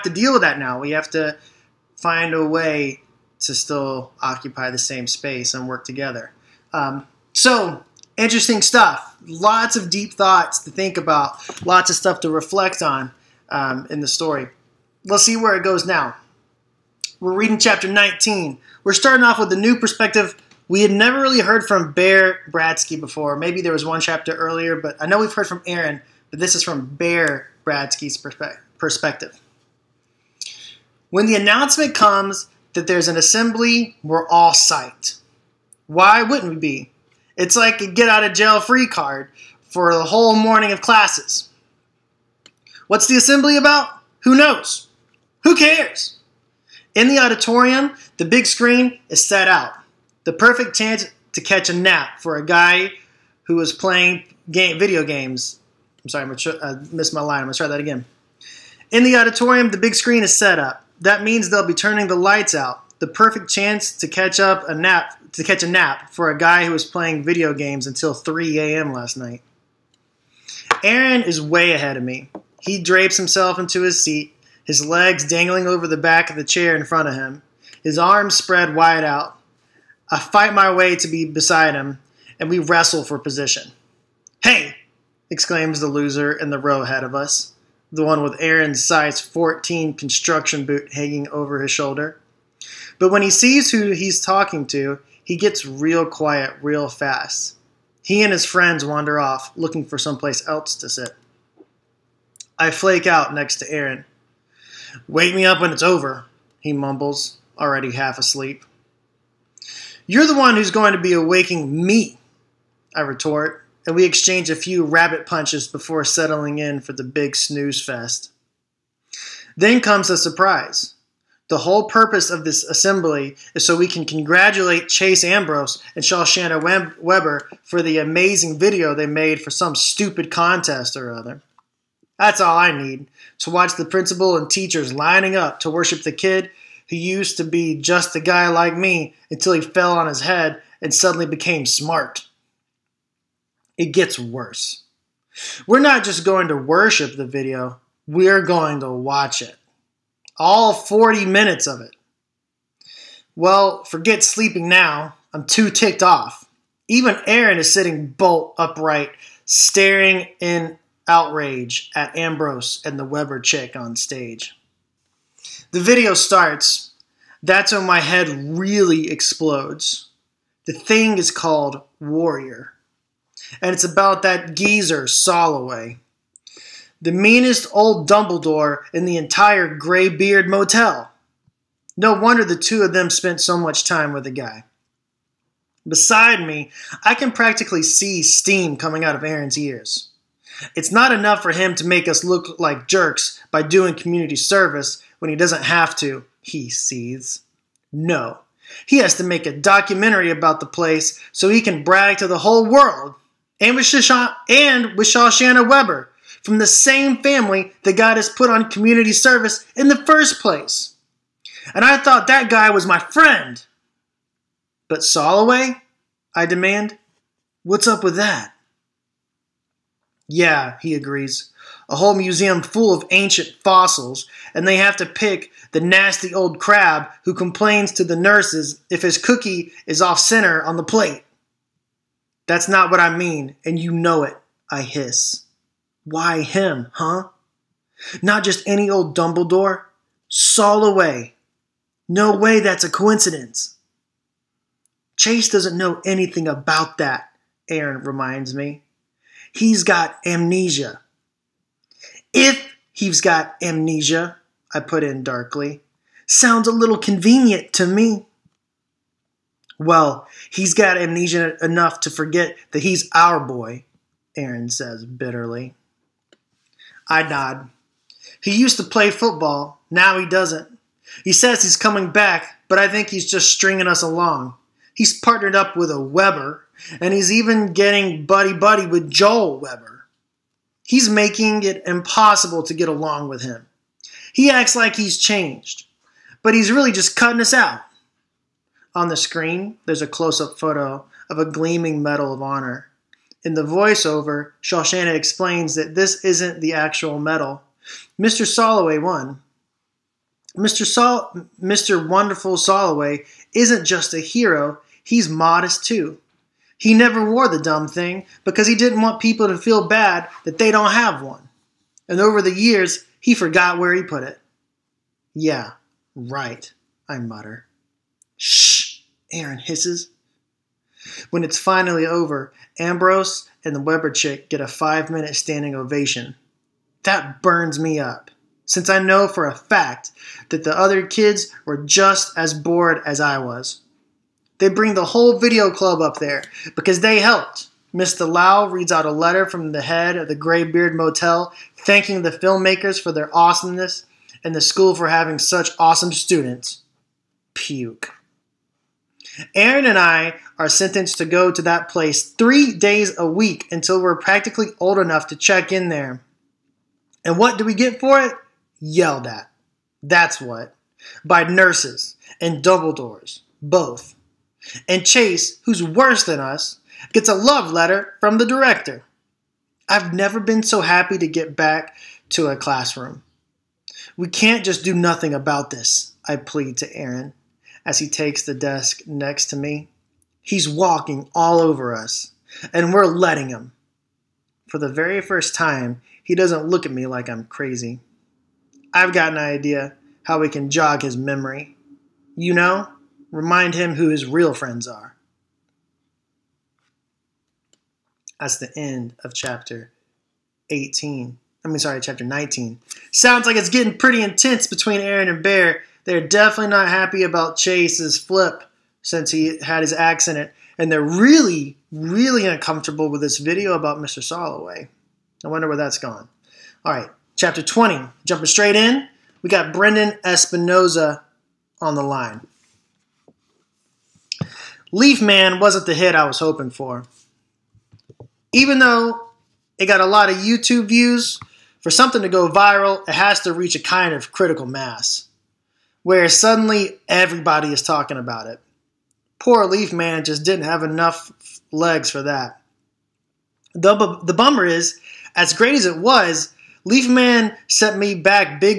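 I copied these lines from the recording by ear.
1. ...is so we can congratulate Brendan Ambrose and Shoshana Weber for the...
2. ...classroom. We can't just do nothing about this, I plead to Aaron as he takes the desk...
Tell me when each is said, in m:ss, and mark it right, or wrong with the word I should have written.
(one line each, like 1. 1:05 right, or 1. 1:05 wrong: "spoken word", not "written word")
1. 2:03 wrong: "Chase", not "Brendan"
2. 6:12 right.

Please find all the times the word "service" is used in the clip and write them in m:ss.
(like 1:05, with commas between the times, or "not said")
3:14, 3:29.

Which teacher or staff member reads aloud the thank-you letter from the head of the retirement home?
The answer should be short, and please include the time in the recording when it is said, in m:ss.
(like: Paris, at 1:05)
Mr. Lau, at 5:37.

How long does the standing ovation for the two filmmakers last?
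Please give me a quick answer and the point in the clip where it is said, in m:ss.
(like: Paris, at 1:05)
5 minutes, at 5:24.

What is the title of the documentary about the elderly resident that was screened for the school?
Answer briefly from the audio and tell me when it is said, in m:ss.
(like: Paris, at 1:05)
Warrior, at 2:51.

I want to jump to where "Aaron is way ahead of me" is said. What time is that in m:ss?
1:10.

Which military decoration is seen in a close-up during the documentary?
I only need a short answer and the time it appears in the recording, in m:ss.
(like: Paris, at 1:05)
Medal of Honor, at 4:52.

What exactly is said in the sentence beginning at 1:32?
But when he sees who he's talking to, he gets real quiet real fast.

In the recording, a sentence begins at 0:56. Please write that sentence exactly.
I'm sorry, I uh, missed my line.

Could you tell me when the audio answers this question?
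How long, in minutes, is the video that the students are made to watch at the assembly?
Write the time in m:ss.
2:30.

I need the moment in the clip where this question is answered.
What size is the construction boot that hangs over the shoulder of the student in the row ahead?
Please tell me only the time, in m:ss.
1:28.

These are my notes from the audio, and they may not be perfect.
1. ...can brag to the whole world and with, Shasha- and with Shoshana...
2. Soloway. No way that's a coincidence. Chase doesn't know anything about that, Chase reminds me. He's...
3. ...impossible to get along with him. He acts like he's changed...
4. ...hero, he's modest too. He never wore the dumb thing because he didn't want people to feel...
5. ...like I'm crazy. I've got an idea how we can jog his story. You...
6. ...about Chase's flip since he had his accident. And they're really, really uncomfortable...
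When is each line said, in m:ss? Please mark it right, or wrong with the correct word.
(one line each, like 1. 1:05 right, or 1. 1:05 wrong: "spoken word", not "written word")
1. 3:21 right
2. 4:00 wrong: "Aaron", not "Chase"
3. 4:41 right
4. 5:04 right
5. 6:27 wrong: "memory", not "story"
6. 6:47 right.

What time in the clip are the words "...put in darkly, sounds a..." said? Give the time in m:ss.
4:14.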